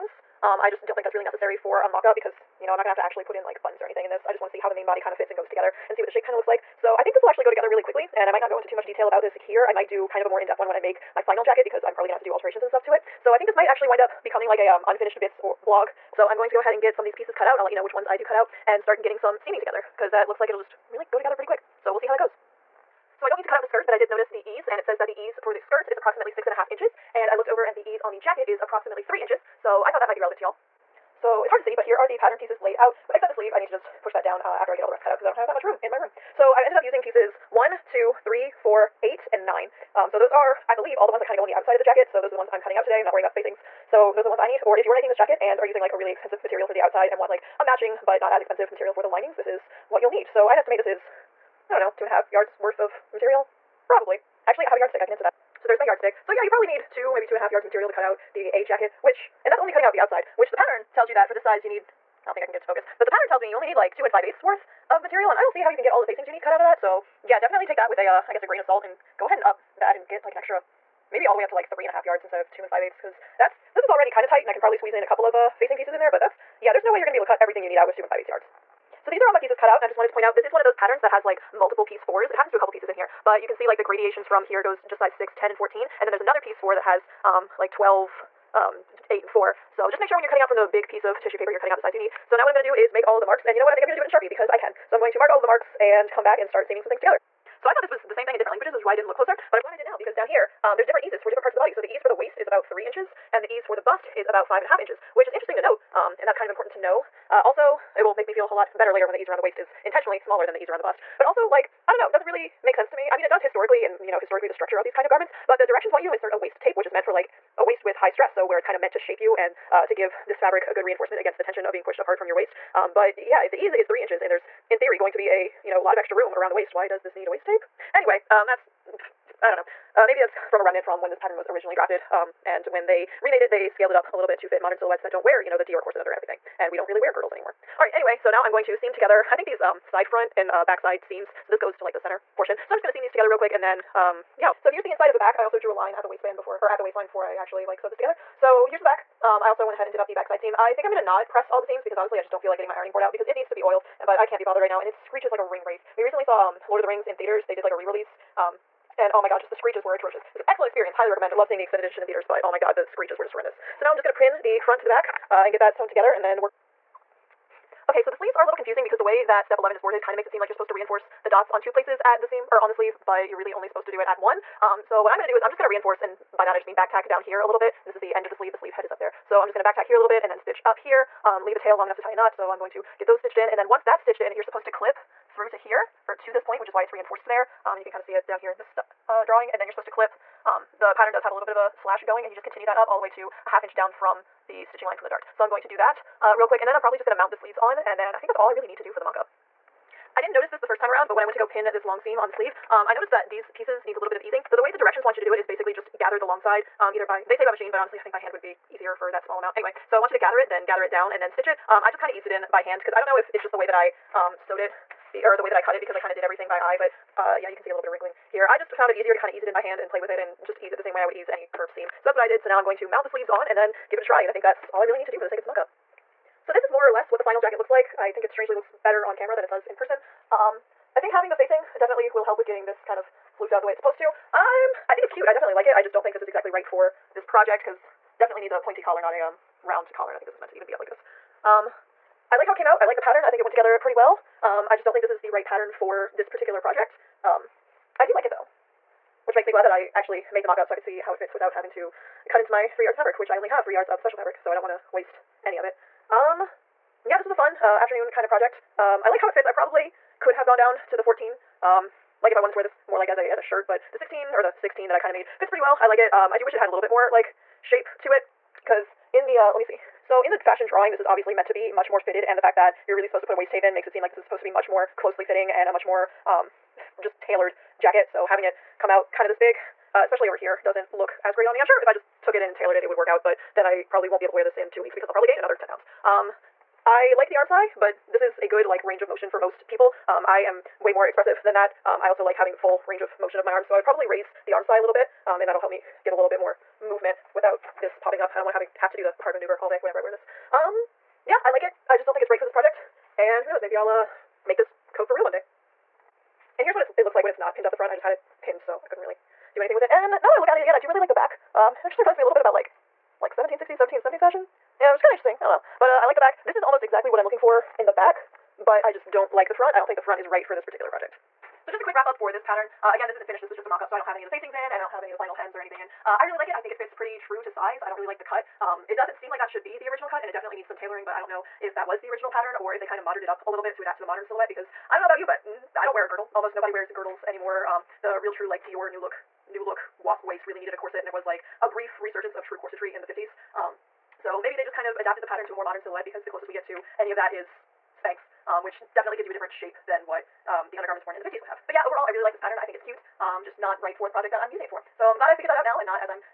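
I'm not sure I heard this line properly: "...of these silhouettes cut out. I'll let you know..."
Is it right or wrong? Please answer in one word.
wrong.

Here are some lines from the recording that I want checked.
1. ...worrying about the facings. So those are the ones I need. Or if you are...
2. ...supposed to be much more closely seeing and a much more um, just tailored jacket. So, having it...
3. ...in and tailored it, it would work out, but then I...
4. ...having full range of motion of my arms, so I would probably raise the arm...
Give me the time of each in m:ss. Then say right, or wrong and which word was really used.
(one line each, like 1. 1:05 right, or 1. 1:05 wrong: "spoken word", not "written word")
1. 0:43 right
2. 4:34 wrong: "fitting", not "seeing"
3. 4:42 right
4. 4:52 right.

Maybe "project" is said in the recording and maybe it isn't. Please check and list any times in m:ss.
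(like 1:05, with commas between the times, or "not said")
3:57, 4:06, 4:18, 5:02, 5:20, 5:54.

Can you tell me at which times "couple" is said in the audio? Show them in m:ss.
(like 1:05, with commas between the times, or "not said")
1:15, 1:22.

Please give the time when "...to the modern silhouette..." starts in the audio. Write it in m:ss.
5:33.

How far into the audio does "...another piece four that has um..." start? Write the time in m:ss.
1:26.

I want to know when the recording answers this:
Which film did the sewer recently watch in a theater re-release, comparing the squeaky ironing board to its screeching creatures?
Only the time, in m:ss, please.
2:36.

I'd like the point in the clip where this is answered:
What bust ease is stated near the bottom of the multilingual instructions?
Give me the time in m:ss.
1:44.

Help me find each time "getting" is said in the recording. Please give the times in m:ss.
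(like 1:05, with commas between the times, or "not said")
0:19, 2:32, 3:52.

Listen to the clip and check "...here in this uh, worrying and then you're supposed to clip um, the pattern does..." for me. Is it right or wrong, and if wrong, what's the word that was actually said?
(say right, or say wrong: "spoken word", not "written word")
wrong: "drawing", not "worrying".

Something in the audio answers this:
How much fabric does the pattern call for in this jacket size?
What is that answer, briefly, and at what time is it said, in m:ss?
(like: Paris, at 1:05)
2 and 5/8 yards, at 1:03.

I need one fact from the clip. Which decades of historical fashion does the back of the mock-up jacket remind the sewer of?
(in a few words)
1760s, 1770s.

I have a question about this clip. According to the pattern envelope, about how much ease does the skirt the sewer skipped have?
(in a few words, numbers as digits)
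6 and a half inches.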